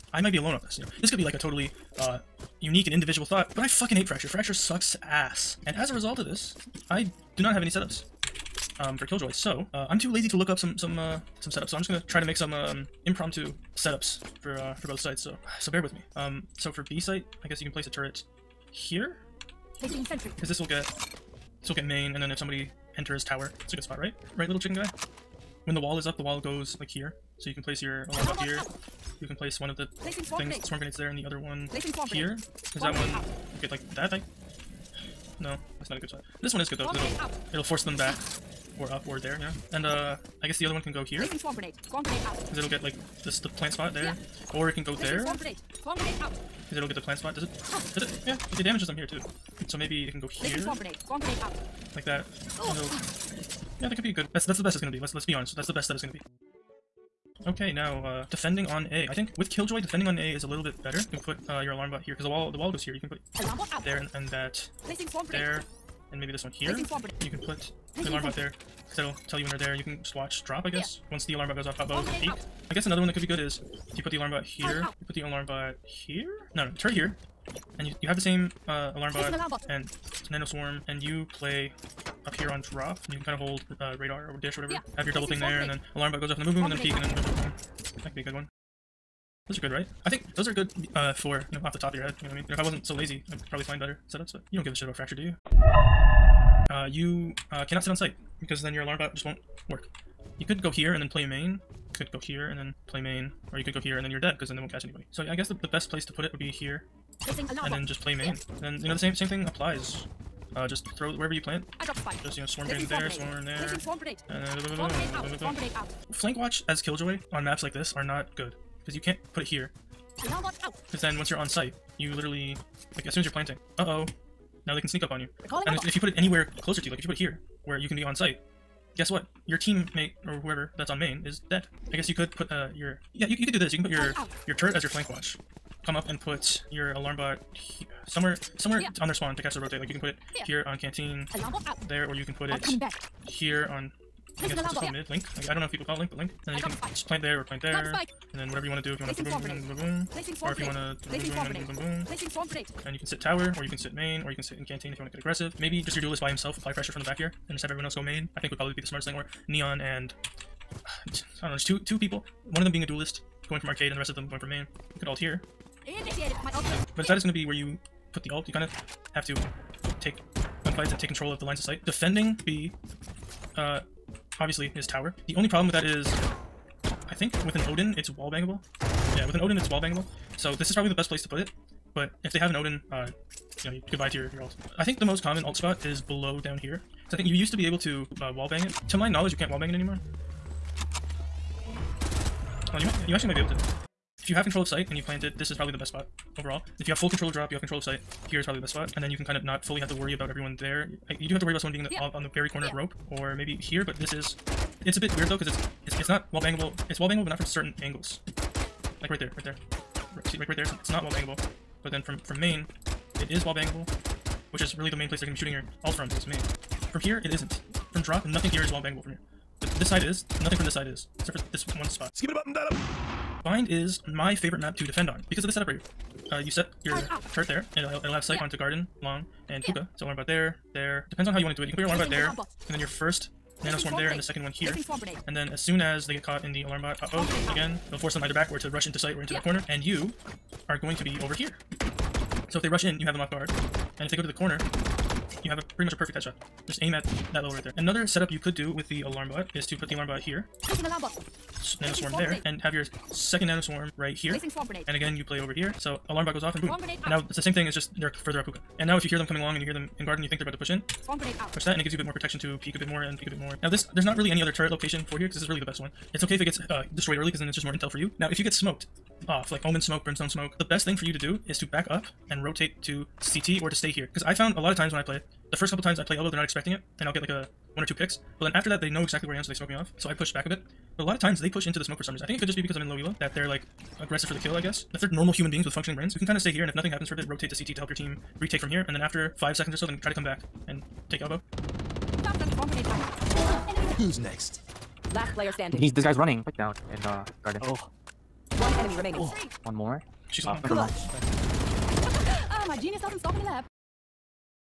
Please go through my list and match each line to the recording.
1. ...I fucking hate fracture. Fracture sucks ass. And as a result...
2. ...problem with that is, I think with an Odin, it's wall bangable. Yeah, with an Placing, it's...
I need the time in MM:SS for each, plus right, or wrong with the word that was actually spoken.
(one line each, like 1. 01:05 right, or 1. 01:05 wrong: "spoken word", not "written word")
1. 00:03 right
2. 02:55 wrong: "Odin", not "Placing".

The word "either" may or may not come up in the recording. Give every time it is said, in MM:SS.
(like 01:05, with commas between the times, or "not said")
03:58.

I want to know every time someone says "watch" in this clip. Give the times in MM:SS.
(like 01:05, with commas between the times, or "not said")
01:10, 01:56, 02:15.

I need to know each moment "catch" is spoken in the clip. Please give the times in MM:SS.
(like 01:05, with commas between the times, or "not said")
01:44, 02:19.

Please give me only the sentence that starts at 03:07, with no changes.
Because I think you used to be able to uh, wall bang it.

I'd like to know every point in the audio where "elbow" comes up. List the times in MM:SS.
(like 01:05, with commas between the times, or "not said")
04:36, 04:51.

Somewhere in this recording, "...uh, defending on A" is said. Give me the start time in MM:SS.
00:58.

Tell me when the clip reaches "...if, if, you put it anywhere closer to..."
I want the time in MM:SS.
02:05.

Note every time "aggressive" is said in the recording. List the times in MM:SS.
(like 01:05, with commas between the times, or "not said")
02:35, 04:43.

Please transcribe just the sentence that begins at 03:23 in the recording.
But this is, it's a bit weird though, because it's it's it's not wall bangable.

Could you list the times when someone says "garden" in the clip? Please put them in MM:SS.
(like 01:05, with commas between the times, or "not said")
03:48, 04:20, 04:57.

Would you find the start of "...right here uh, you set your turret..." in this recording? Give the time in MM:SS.
03:45.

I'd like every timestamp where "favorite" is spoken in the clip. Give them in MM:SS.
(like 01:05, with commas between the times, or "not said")
03:44.